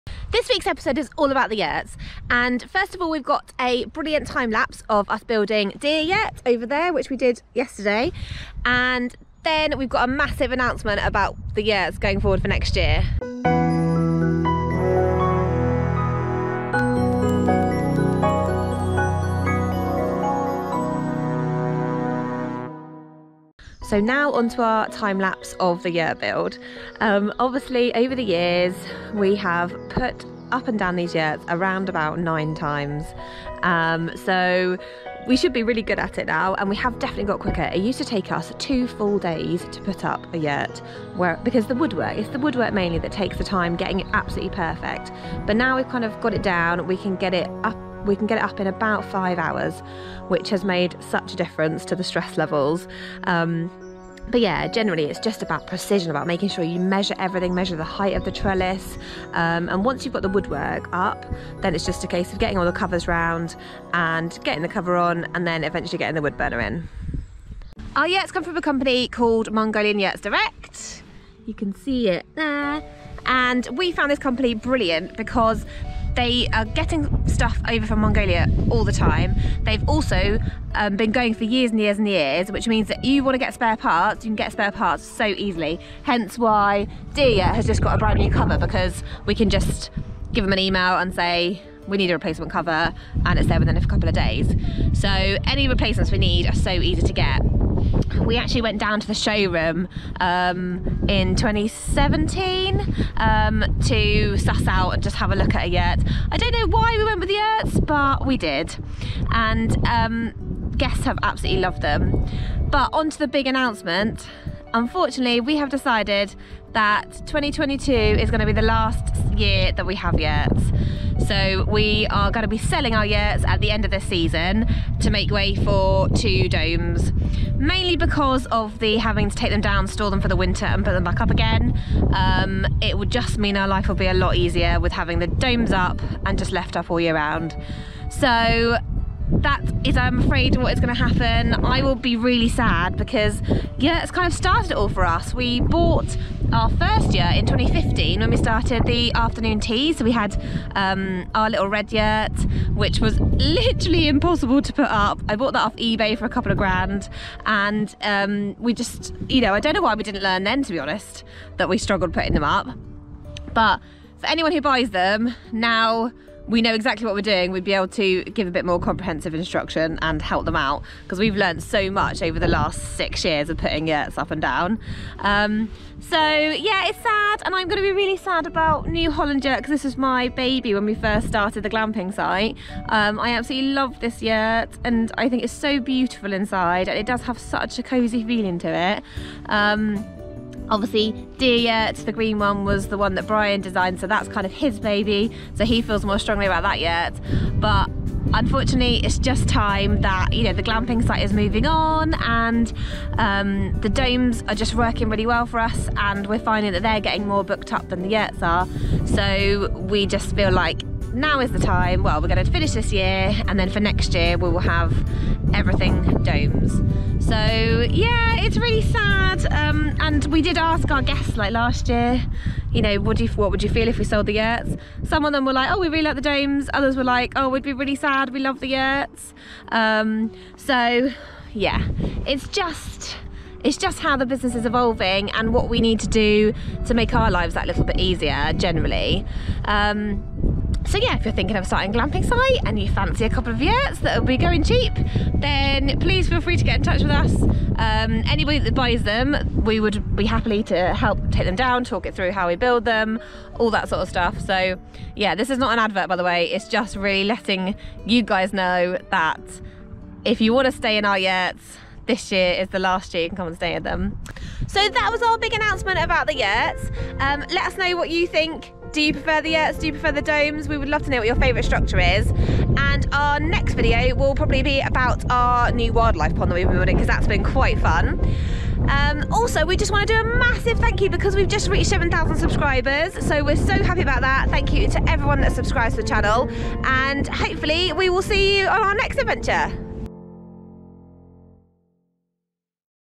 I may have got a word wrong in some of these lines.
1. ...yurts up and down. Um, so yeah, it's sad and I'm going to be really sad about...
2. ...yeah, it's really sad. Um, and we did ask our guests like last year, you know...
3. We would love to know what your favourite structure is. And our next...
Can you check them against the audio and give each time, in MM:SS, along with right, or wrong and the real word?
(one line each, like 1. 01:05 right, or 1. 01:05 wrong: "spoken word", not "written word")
1. 02:53 right
2. 03:37 right
3. 04:30 right.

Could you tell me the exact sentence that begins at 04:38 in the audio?
Um, also, we just want to do a massive thank you because we've just reached 7,000 subscribers.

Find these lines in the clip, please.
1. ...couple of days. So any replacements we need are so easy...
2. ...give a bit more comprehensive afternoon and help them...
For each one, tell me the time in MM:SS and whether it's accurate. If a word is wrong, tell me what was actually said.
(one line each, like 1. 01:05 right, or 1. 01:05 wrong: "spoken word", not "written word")
1. 01:33 right
2. 02:48 wrong: "instruction", not "afternoon".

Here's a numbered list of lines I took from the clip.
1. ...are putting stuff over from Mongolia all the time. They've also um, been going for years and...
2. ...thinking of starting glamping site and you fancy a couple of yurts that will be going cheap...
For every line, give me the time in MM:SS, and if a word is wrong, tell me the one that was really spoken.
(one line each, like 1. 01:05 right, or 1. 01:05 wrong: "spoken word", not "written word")
1. 01:16 wrong: "getting", not "putting"
2. 04:01 right.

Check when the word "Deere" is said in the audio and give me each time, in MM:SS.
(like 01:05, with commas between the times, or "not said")
00:05, 03:11.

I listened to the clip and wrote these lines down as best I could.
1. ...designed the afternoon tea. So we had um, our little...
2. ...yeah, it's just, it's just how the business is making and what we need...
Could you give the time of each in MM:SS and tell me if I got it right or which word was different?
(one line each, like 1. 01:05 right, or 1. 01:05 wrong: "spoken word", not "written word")
1. 02:28 wrong: "started", not "designed"
2. 03:51 wrong: "evolving", not "making".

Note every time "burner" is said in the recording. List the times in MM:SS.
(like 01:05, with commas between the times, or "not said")
01:06.